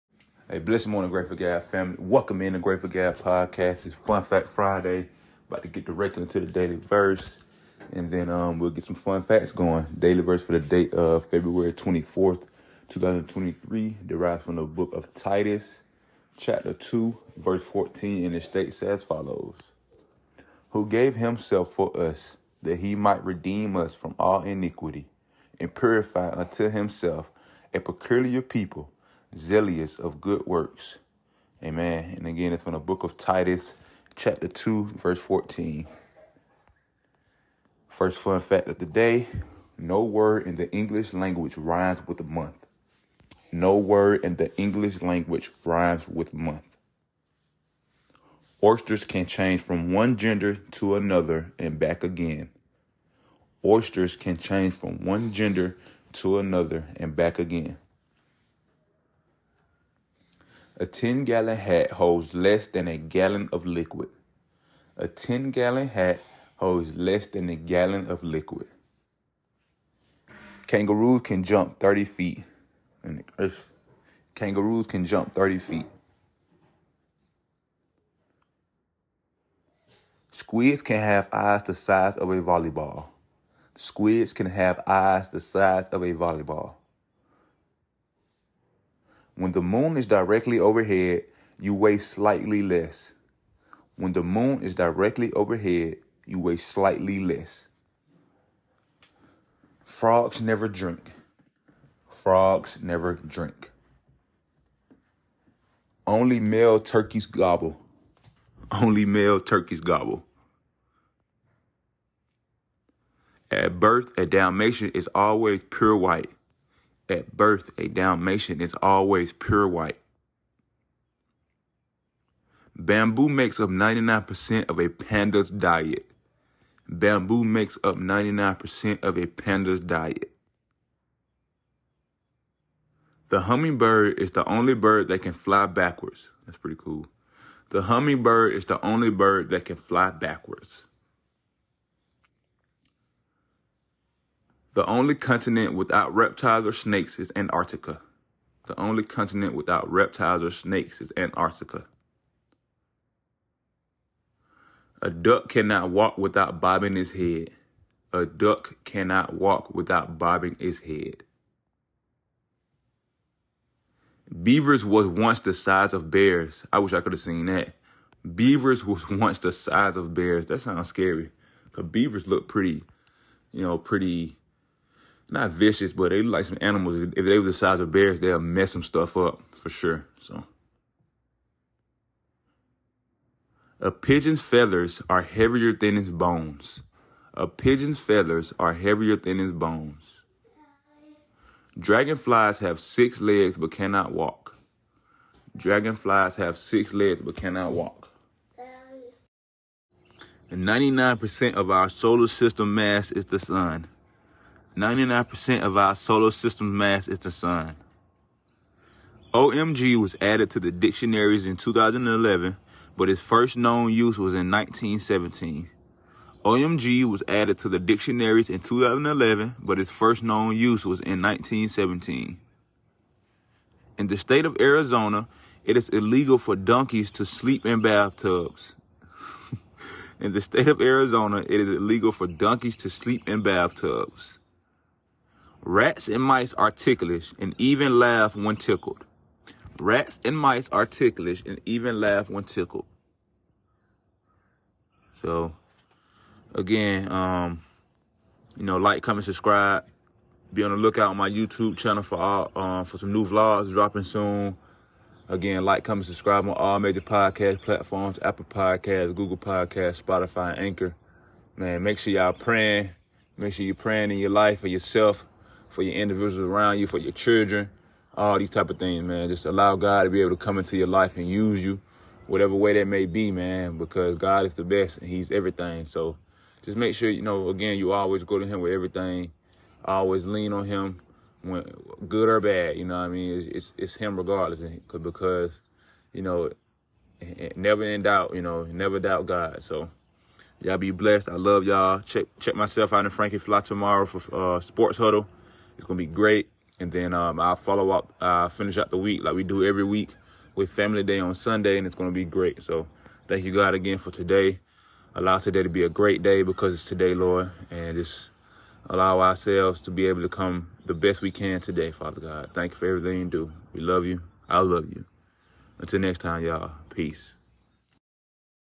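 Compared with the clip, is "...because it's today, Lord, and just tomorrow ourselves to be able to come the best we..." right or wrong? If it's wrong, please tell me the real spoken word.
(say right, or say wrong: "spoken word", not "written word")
wrong: "allow", not "tomorrow".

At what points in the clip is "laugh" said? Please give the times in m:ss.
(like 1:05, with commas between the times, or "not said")
3:57, 4:01.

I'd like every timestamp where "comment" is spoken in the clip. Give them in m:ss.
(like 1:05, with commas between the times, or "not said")
4:09, 4:15.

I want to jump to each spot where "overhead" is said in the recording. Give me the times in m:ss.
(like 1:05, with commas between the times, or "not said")
1:30, 1:35.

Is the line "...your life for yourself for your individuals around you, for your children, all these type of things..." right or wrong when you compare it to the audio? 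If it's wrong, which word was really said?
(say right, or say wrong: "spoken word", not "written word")
right.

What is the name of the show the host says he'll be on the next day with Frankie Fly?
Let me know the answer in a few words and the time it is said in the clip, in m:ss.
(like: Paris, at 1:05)
Sports Huddle, at 4:54.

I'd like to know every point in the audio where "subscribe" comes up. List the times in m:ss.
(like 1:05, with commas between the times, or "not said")
4:09, 4:16.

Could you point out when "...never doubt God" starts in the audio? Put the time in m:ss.
4:48.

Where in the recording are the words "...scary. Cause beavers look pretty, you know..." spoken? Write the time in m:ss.
2:50.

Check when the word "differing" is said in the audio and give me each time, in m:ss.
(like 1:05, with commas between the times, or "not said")
not said.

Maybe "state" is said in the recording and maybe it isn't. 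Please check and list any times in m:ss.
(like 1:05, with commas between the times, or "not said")
0:18, 3:44, 3:50.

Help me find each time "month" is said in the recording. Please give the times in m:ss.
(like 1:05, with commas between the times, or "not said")
0:42, 0:46.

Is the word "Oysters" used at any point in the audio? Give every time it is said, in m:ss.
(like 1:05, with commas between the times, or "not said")
0:48, 0:53.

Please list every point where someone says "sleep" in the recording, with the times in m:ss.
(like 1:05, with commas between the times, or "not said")
3:47, 3:52.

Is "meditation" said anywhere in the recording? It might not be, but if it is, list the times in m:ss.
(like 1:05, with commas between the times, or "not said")
not said.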